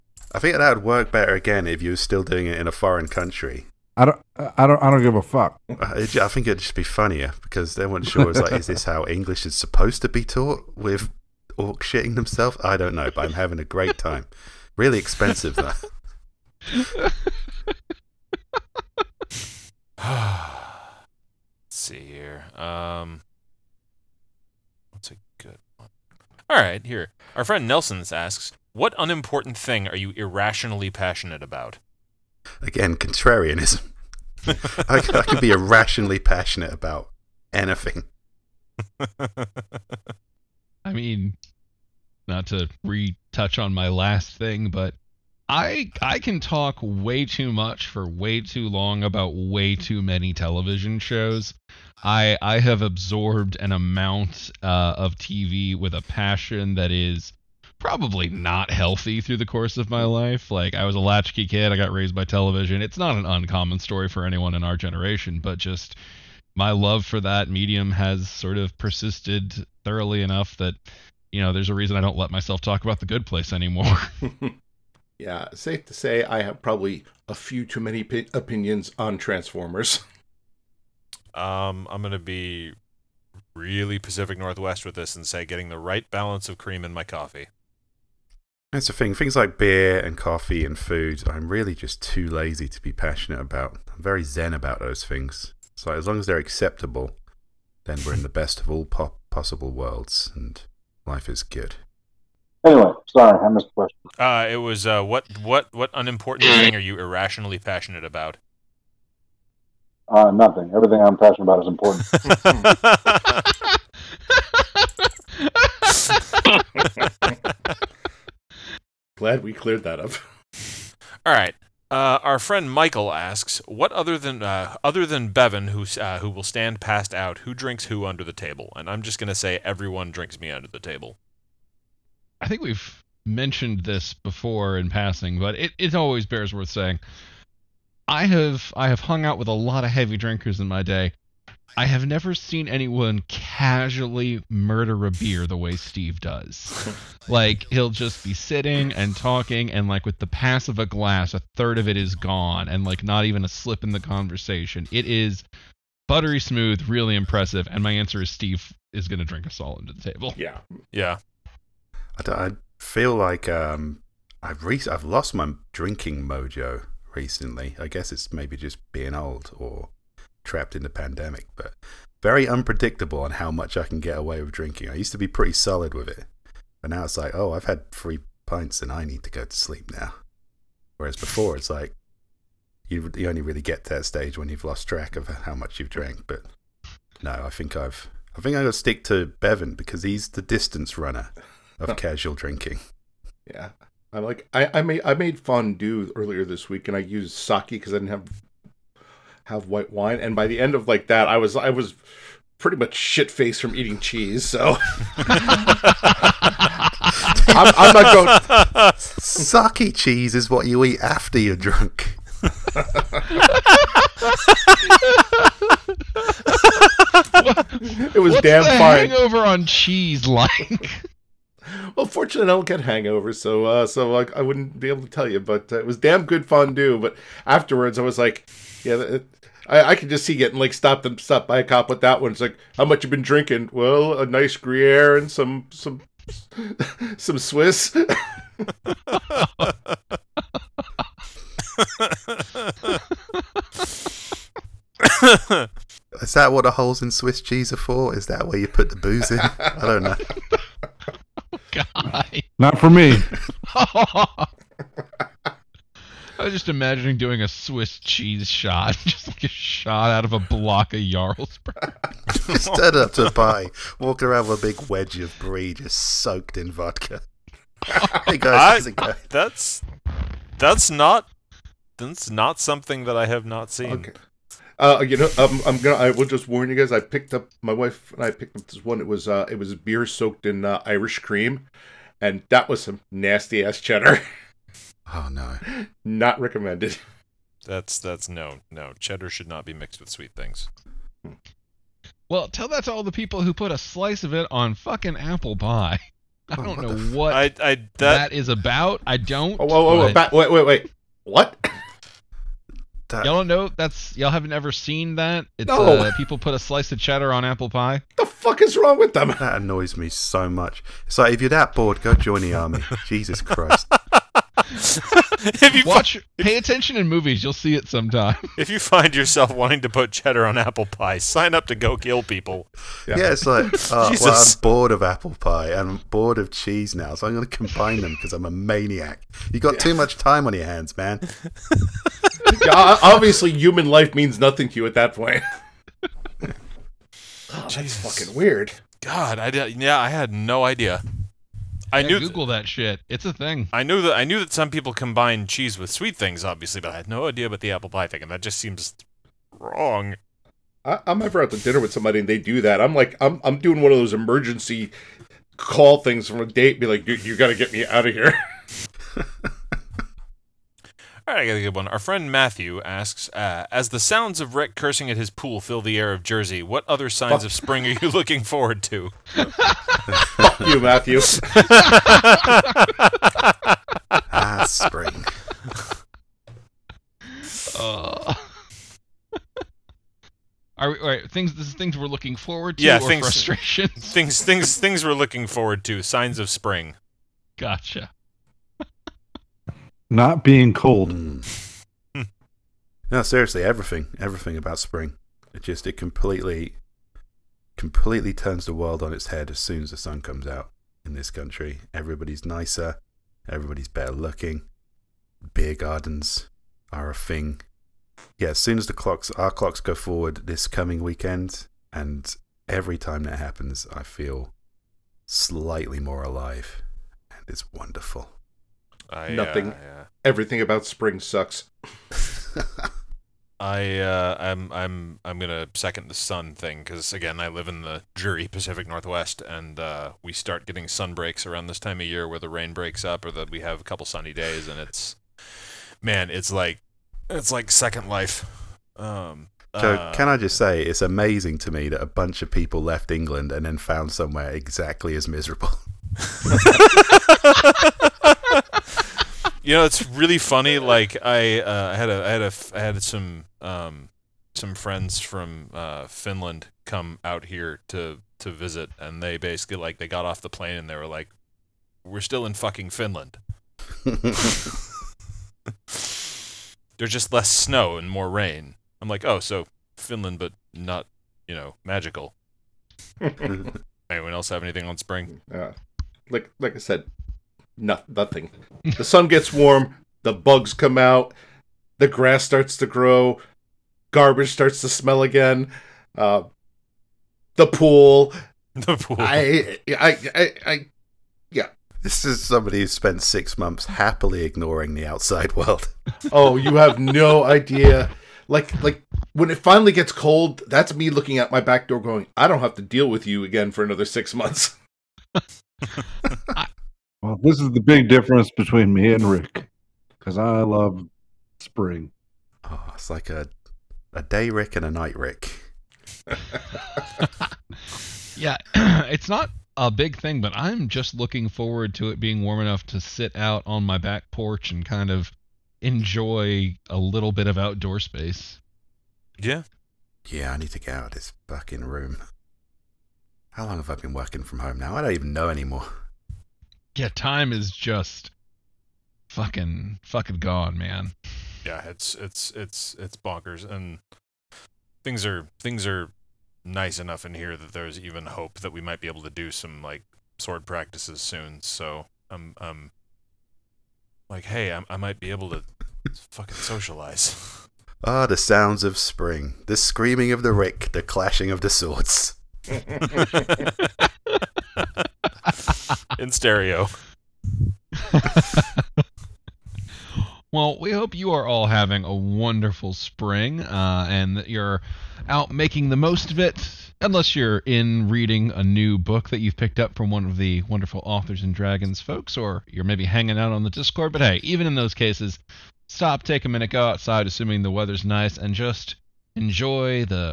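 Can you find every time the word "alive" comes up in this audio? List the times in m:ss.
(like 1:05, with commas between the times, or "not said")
6:56.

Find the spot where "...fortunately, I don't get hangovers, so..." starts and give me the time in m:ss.
3:42.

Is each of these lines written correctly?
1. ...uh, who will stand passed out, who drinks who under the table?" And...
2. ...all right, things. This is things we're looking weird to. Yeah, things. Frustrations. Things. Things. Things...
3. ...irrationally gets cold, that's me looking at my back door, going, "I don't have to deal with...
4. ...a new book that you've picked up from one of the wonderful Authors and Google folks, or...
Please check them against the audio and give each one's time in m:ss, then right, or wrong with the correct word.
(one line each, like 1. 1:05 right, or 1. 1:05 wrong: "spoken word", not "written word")
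1. 2:05 right
2. 6:20 wrong: "forward", not "weird"
3. 8:19 wrong: "finally", not "irrationally"
4. 9:38 wrong: "Dragons", not "Google".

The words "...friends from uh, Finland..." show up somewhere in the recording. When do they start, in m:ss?
7:34.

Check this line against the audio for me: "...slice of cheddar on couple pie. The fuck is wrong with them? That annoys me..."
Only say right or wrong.
wrong.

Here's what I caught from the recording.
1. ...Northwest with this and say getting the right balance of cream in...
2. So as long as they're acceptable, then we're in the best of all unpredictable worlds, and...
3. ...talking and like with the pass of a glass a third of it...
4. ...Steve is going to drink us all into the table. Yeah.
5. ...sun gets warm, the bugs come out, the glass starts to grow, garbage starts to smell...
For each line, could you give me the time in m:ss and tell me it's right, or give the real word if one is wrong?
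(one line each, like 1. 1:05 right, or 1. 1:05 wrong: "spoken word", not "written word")
1. 1:24 right
2. 1:35 wrong: "possible", not "unpredictable"
3. 2:29 right
4. 2:38 right
5. 7:59 wrong: "grass", not "glass".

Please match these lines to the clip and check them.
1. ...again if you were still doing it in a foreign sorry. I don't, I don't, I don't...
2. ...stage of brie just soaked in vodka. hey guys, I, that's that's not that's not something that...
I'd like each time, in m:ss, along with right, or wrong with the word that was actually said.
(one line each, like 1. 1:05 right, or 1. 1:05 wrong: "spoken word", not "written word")
1. 0:01 wrong: "country", not "sorry"
2. 4:24 wrong: "wedge", not "stage".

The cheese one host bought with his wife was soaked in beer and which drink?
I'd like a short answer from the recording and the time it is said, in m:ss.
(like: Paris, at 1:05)
Irish cream, at 4:40.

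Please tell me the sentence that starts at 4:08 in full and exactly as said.
Is that where you put the booze in?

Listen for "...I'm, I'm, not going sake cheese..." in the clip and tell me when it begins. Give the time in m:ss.
3:25.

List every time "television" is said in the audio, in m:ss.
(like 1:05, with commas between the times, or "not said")
0:50, 1:02.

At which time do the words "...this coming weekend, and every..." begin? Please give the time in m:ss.
6:50.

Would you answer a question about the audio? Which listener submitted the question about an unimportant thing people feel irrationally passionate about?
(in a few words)
Nelson.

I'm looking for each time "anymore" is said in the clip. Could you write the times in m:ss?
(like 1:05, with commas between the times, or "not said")
1:13, 8:55.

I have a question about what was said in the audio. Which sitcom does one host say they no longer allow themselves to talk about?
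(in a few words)
The Good Place.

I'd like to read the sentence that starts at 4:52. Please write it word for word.
Well, tell that to all the people who put a slice of it on fucking apple pie.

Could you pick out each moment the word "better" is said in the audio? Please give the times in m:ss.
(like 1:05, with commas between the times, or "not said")
0:01, 6:43.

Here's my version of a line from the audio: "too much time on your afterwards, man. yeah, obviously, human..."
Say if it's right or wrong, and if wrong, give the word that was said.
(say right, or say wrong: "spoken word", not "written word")
wrong: "hands", not "afterwards".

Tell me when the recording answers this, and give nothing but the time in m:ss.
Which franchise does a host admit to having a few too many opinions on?
1:19.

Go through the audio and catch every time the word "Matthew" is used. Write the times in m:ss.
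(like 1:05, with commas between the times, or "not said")
6:02, 6:10.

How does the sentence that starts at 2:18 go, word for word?
I have I have hung out with a lot of heavy drinkers in my day.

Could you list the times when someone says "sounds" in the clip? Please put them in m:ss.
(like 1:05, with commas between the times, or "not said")
6:03, 9:18.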